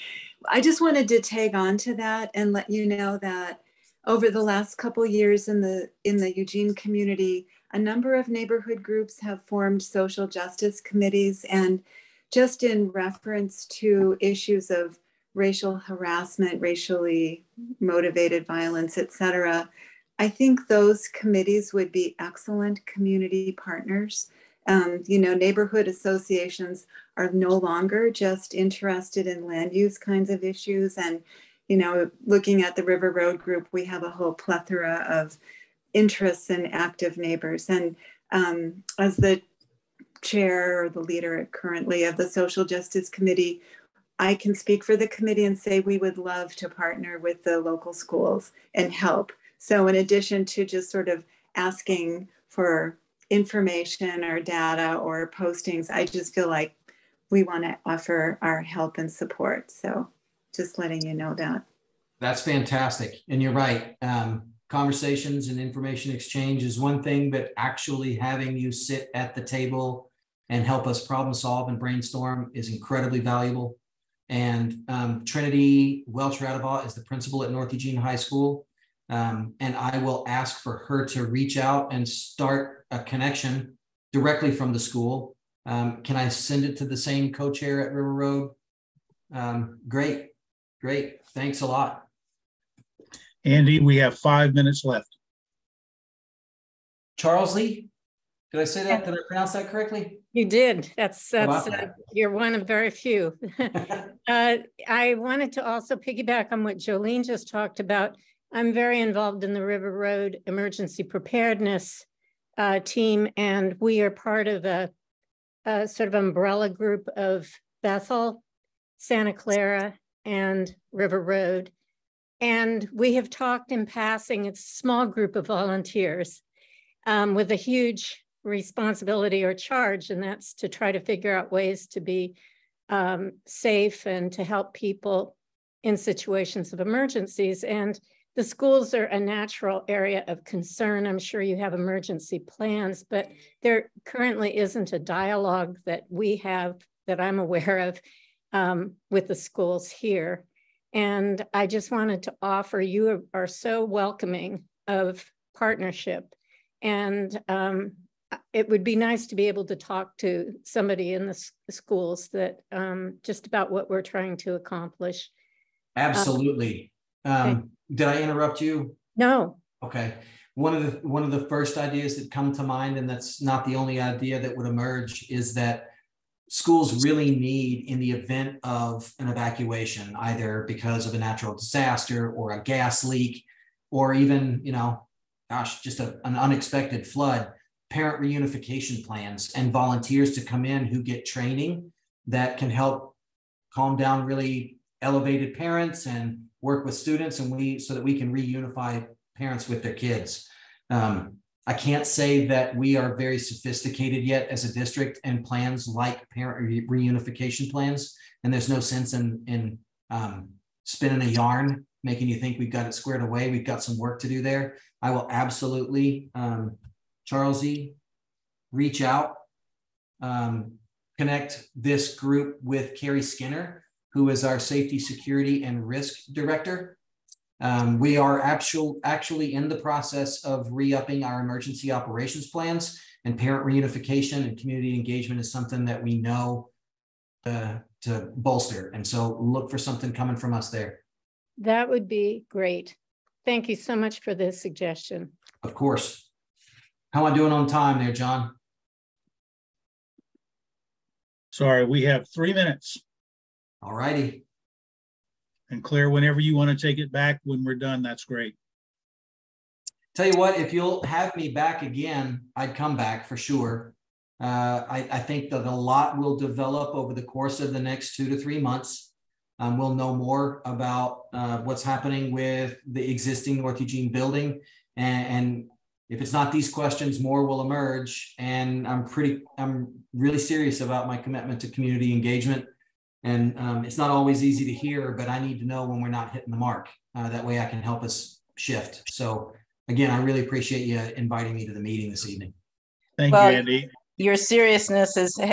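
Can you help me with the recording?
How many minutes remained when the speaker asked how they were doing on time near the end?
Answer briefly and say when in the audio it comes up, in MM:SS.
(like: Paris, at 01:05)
3, at 04:12.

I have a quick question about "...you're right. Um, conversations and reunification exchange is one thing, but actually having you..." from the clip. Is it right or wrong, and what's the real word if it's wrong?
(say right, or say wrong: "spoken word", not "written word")
wrong: "information", not "reunification".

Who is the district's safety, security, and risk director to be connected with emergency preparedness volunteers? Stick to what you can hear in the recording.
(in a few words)
Carrie Skinner.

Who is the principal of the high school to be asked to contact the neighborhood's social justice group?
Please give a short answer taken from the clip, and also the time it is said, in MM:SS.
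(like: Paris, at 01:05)
Trinity Welch Radabaugh, at 01:15.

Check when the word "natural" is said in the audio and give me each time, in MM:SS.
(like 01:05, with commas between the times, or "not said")
02:19, 03:01.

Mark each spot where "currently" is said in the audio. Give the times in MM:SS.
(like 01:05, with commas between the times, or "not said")
00:41, 02:24.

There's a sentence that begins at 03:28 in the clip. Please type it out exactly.
And there's no sense in, in um, spinning a yarn, making you think we've got it squared away.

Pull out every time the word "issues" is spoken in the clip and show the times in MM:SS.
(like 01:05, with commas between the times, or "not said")
00:14, 00:30.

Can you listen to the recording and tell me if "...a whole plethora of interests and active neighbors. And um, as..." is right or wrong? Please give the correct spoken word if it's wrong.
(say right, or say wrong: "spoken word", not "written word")
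right.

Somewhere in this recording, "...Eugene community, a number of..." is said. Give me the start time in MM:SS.
00:06.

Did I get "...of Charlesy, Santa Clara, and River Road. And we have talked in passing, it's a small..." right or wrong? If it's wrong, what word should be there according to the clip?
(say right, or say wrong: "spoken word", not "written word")
wrong: "Bethel", not "Charlesy".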